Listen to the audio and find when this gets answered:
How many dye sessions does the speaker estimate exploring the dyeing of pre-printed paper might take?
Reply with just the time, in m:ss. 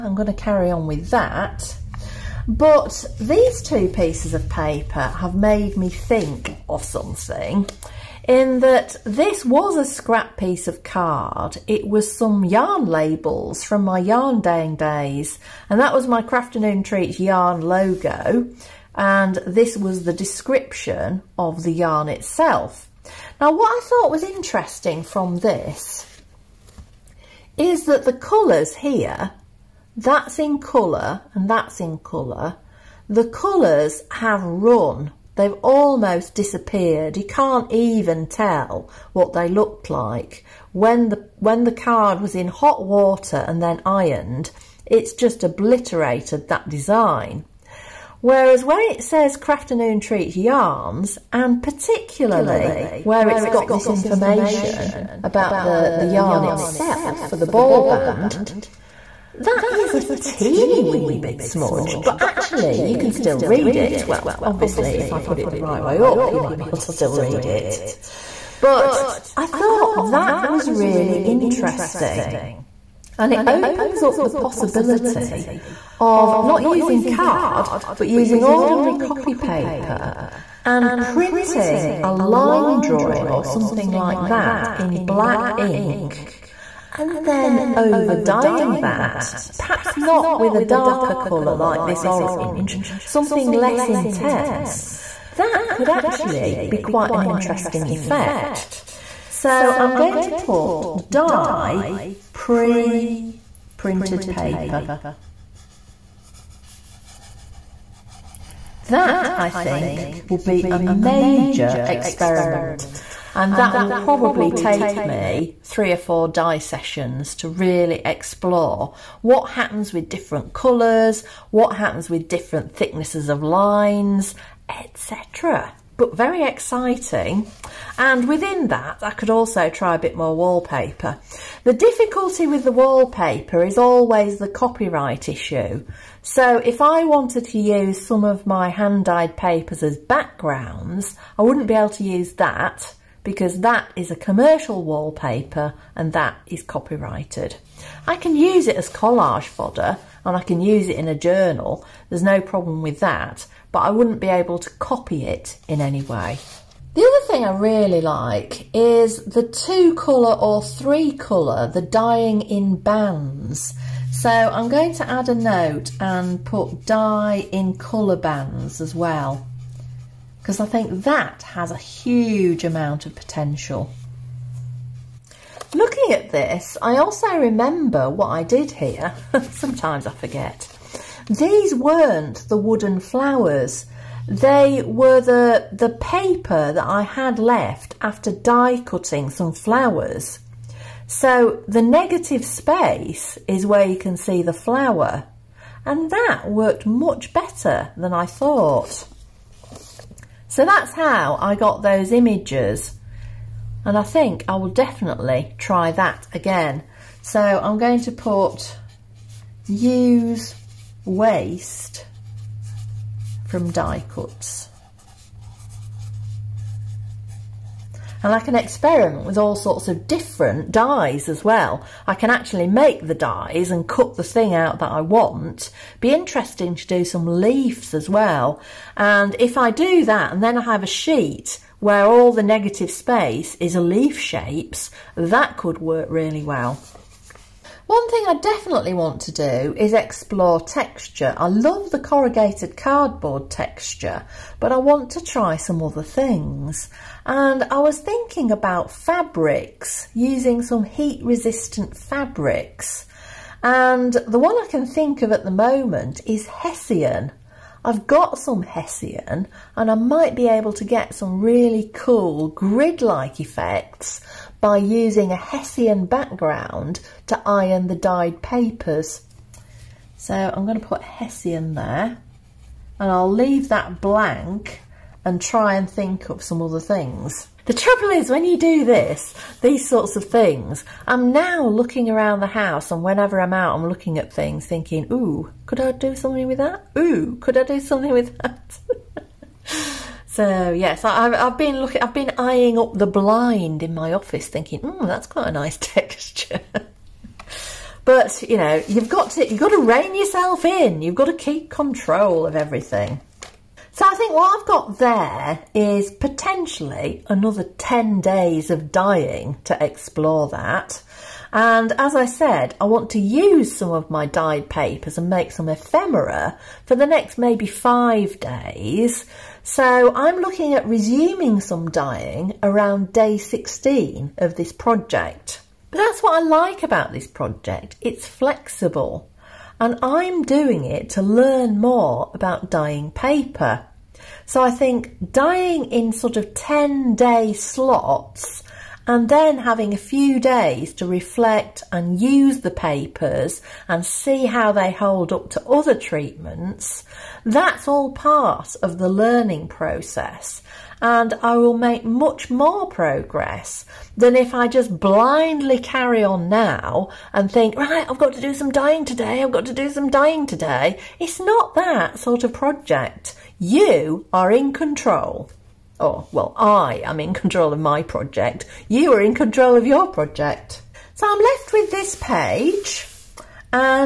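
1:55.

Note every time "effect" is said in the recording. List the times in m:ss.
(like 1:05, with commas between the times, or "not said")
1:37, 4:23.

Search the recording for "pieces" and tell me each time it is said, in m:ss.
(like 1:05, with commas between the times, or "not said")
0:03, 0:10.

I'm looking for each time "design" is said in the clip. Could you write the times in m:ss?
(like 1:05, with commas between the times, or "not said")
0:46.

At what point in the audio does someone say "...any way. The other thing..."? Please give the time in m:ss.
2:35.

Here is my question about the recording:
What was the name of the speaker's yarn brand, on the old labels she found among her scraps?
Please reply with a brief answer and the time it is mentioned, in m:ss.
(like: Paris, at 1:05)
Crafternoon Treats, at 0:16.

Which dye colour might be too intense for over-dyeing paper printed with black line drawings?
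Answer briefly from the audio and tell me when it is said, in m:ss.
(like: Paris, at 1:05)
orange, at 1:32.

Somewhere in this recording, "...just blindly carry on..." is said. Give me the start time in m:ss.
5:54.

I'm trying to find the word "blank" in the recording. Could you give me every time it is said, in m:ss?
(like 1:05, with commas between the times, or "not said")
4:34.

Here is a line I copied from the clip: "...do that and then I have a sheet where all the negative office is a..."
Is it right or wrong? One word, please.
wrong.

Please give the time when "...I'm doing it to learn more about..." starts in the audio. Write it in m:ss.
5:30.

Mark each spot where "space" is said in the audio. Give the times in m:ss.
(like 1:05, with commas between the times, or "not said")
3:12, 3:52.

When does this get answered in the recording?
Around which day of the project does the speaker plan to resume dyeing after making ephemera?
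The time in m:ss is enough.
5:23.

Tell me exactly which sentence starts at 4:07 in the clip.
And I was thinking about fabrics, using some heat resistant fabrics.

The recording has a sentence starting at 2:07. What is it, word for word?
And within that, I could also try a bit more wallpaper.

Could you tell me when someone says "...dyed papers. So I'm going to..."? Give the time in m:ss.
4:27.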